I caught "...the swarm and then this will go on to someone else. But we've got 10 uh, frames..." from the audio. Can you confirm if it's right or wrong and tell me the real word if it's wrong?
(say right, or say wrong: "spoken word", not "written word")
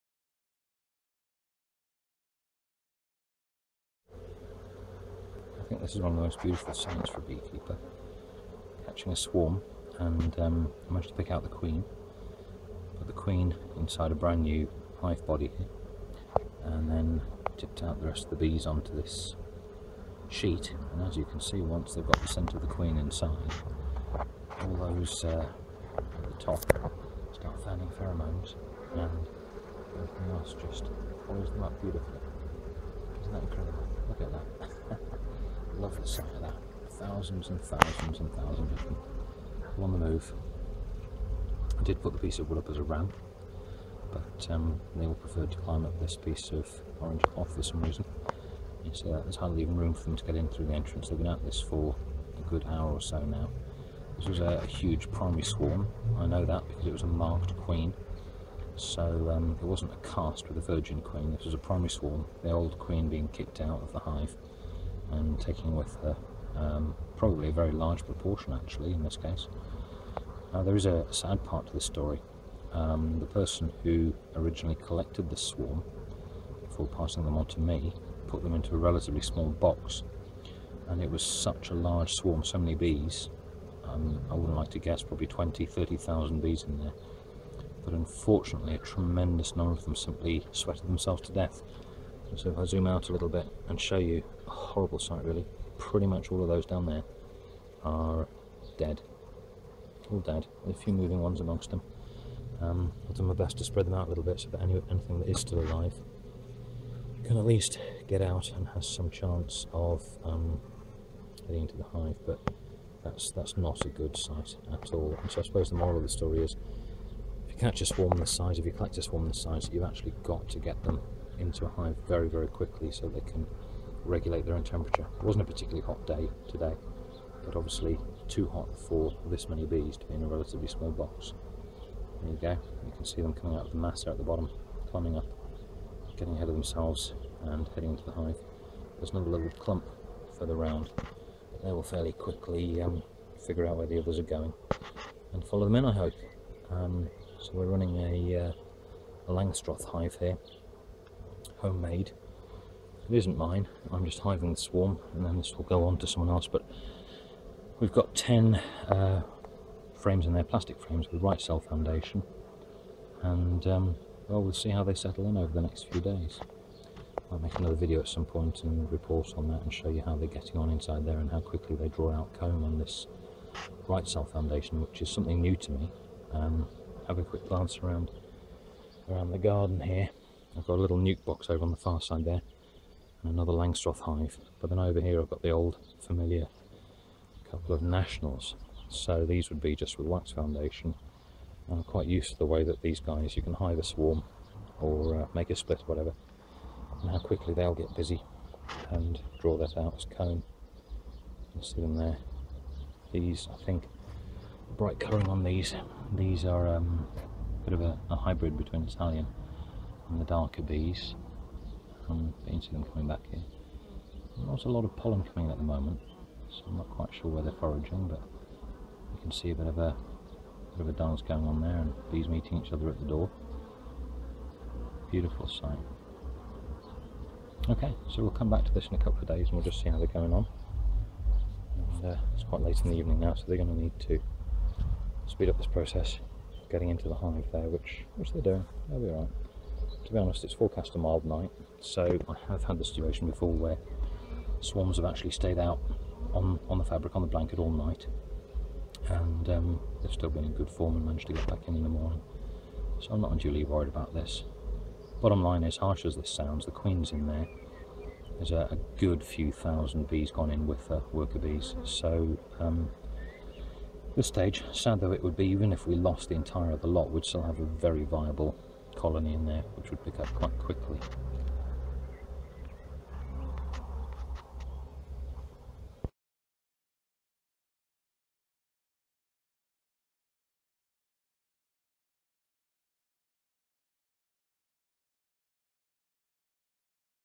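right.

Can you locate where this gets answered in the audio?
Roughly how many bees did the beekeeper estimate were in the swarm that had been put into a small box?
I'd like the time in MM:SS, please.
01:25.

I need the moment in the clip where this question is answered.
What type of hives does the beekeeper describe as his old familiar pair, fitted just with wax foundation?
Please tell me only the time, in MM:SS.
03:07.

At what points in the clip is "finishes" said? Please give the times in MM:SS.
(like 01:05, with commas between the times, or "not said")
not said.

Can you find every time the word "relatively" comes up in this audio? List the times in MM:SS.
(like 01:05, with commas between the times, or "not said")
01:18, 02:10.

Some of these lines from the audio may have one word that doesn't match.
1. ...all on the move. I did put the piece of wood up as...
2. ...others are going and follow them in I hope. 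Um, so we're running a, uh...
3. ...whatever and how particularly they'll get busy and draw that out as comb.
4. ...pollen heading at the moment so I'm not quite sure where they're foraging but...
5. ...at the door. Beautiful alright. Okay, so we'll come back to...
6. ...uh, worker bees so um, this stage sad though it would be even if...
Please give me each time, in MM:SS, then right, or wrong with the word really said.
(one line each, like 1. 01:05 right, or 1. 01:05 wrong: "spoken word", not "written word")
1. 00:39 right
2. 02:23 right
3. 03:15 wrong: "quickly", not "particularly"
4. 03:34 wrong: "coming", not "heading"
5. 03:42 wrong: "sight", not "alright"
6. 04:20 right.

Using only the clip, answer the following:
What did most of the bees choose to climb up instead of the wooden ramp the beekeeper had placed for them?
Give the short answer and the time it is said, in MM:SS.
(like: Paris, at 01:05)
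orange cloth, at 00:46.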